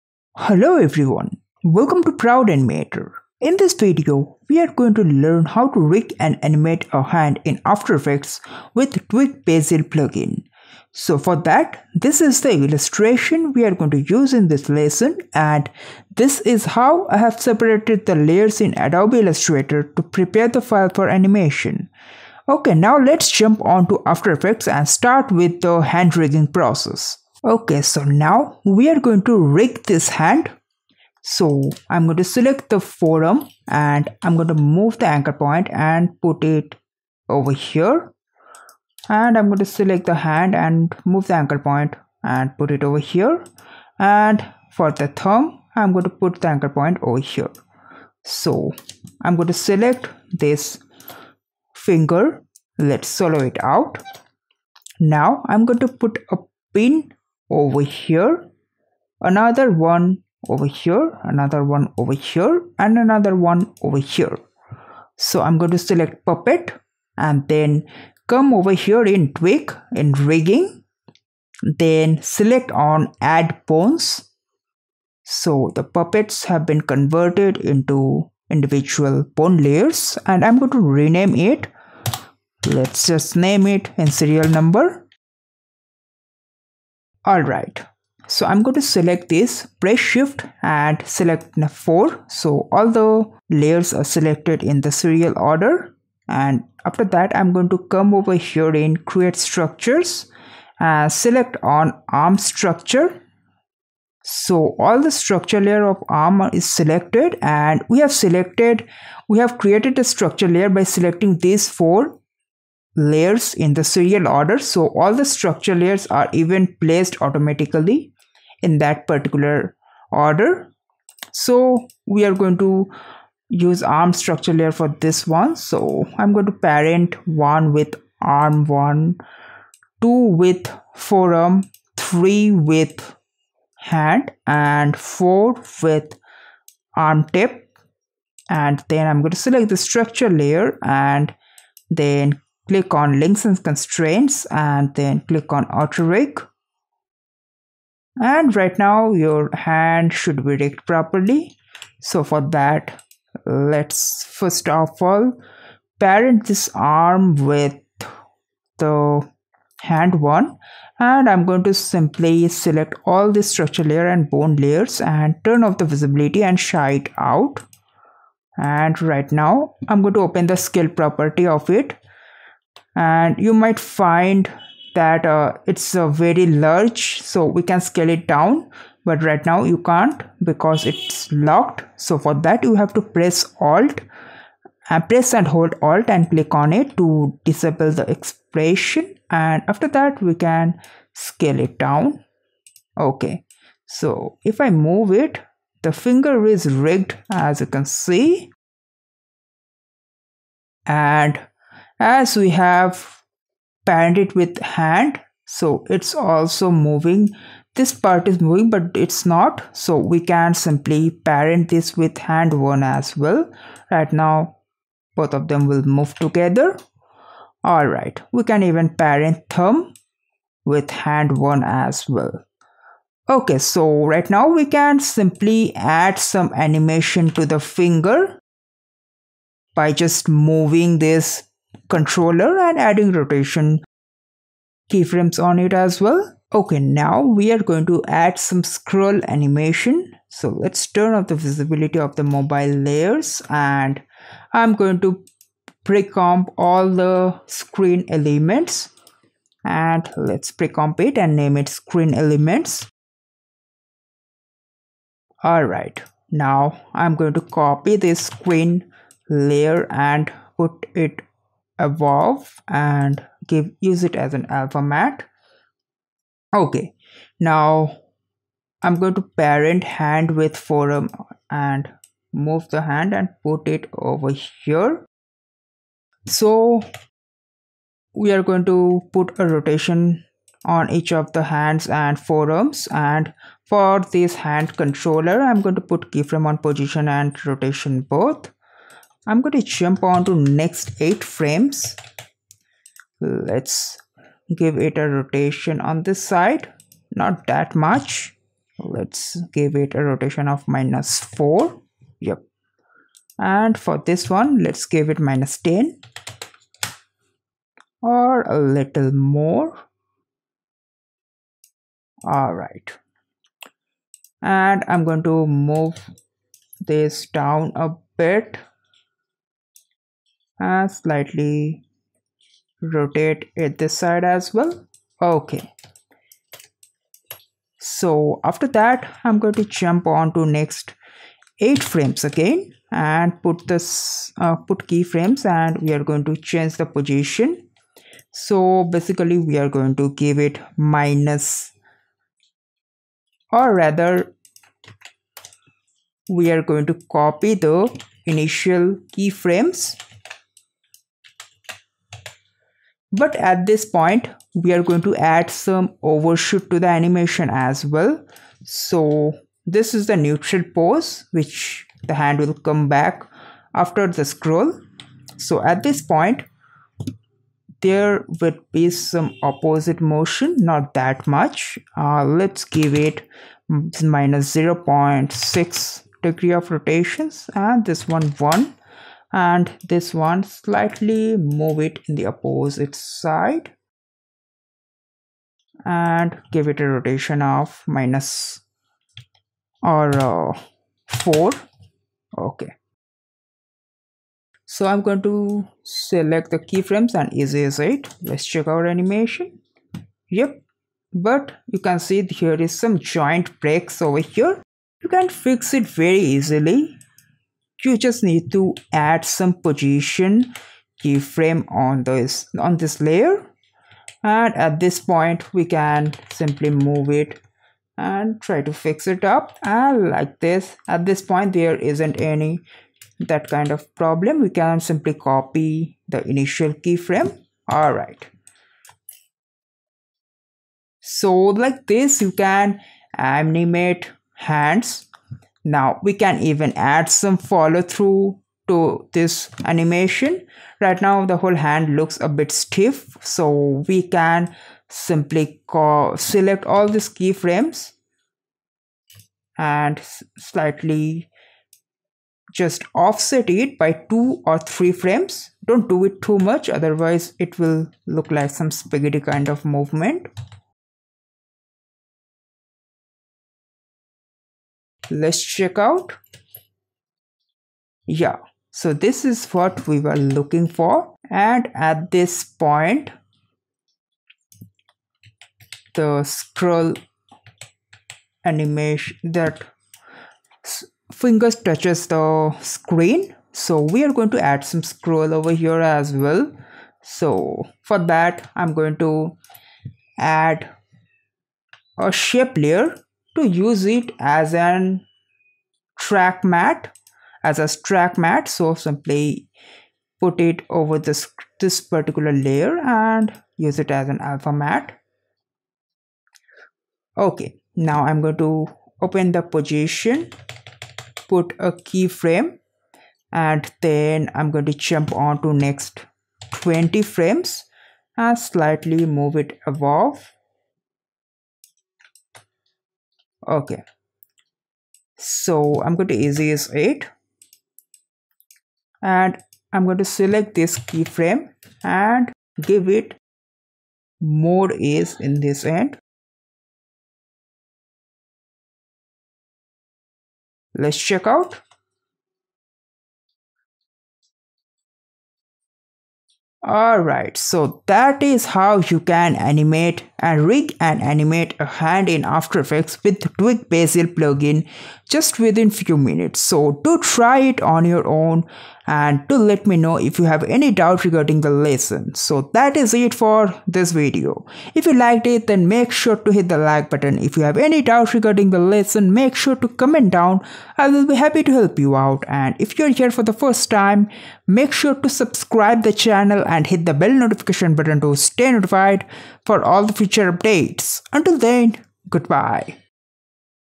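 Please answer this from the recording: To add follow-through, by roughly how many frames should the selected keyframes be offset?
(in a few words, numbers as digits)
2 or 3.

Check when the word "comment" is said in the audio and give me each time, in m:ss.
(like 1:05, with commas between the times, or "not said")
9:29.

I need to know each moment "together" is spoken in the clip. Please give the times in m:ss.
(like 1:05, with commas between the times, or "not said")
3:36.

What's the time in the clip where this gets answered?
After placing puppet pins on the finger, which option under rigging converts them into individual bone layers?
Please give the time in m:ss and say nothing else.
1:13.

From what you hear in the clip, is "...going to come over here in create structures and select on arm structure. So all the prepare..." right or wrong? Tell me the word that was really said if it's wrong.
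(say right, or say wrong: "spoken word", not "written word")
wrong: "structure", not "prepare".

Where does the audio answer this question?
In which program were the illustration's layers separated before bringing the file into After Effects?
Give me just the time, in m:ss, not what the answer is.
0:18.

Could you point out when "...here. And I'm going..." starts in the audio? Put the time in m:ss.
0:37.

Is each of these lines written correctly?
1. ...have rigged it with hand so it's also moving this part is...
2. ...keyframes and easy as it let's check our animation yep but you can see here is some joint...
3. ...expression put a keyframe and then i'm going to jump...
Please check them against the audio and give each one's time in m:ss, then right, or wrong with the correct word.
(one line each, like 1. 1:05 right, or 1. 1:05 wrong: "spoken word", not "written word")
1. 3:22 wrong: "panned", not "rigged"
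2. 6:36 right
3. 8:29 wrong: "position", not "expression".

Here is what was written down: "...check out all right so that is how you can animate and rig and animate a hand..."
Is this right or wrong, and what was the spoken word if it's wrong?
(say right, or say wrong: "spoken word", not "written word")
right.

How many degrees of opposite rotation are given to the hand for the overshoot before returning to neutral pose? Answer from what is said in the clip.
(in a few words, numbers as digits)
-0.6.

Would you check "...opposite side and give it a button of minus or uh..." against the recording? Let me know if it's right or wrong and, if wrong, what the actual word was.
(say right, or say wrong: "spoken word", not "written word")
wrong: "rotation", not "button".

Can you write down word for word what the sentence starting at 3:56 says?
Okay, now we are going to add some scroll animation.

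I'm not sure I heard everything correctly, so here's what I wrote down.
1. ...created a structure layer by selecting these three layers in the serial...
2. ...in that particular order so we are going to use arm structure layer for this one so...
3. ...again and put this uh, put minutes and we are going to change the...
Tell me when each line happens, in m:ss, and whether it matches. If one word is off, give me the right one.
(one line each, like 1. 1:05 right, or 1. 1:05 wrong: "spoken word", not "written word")
1. 1:49 wrong: "four", not "three"
2. 1:58 right
3. 5:32 wrong: "keyframes", not "minutes".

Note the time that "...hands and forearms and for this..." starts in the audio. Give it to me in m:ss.
4:41.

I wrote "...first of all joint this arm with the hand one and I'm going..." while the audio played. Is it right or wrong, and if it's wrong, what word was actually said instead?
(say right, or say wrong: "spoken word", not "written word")
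wrong: "parent", not "joint".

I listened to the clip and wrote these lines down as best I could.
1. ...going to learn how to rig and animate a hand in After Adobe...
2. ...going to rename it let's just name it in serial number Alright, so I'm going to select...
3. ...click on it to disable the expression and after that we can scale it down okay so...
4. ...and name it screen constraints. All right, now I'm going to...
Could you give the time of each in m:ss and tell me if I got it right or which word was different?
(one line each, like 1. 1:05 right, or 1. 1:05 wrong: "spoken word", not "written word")
1. 0:04 wrong: "Effects", not "Adobe"
2. 1:20 right
3. 3:06 right
4. 4:11 wrong: "elements", not "constraints".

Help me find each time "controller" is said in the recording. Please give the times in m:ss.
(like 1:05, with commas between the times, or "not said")
3:51, 4:44.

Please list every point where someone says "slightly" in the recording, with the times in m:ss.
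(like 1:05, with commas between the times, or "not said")
5:20, 6:20, 7:30, 8:38.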